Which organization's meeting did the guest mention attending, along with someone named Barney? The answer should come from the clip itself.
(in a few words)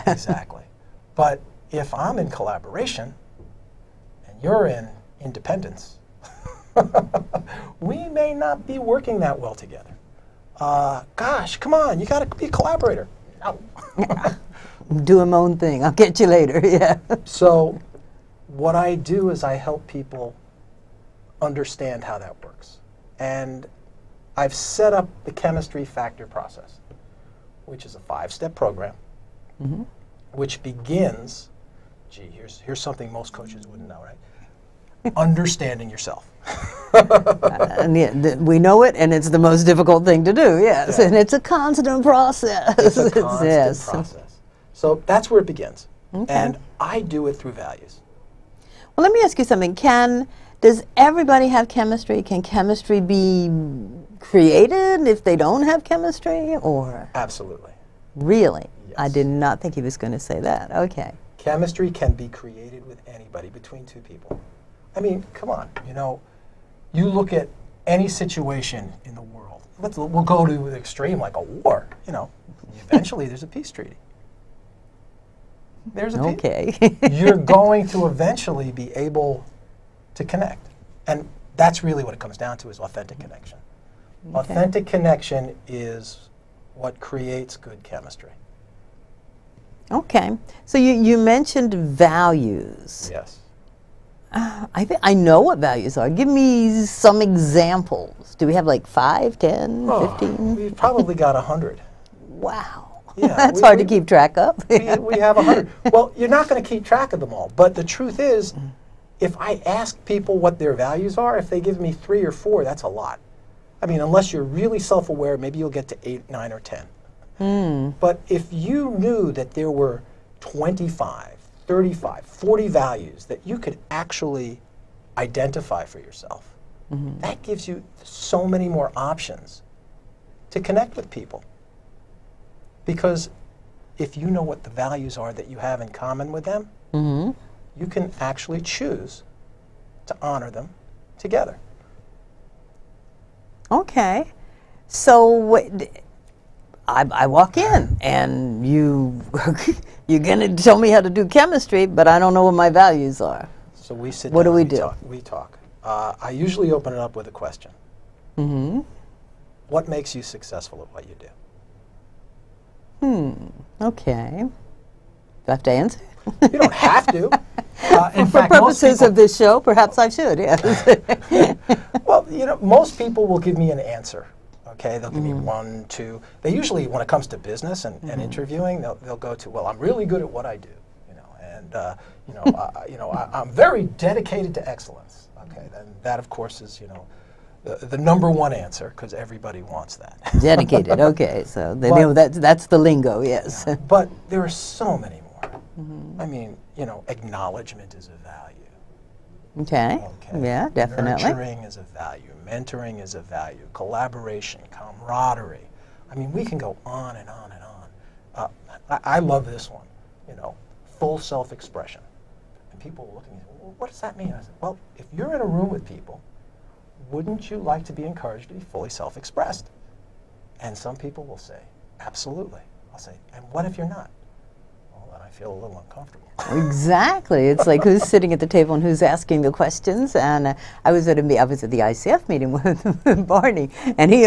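ICF.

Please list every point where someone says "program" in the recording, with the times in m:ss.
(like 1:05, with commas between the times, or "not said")
0:28.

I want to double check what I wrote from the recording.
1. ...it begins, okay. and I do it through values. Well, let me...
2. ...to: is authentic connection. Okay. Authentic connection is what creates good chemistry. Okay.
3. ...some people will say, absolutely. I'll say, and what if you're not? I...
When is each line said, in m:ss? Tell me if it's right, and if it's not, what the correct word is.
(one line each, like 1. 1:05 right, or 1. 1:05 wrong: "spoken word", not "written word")
1. 0:45 right
2. 1:22 right
3. 3:40 right.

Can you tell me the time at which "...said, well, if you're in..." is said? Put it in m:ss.
3:34.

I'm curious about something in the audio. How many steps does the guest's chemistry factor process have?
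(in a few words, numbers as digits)
5.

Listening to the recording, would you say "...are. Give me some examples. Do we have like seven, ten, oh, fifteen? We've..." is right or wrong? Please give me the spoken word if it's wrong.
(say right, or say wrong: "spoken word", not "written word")
wrong: "five", not "seven".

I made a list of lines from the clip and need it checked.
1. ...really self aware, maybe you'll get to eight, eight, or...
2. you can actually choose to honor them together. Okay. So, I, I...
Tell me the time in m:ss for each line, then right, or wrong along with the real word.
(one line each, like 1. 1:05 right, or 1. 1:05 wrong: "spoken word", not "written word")
1. 1:54 wrong: "nine", not "eight"
2. 2:17 right.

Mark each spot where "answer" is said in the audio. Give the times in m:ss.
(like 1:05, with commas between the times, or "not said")
2:45, 2:53, 3:08.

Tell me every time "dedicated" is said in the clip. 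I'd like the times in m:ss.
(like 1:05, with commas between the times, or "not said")
3:04, 3:10.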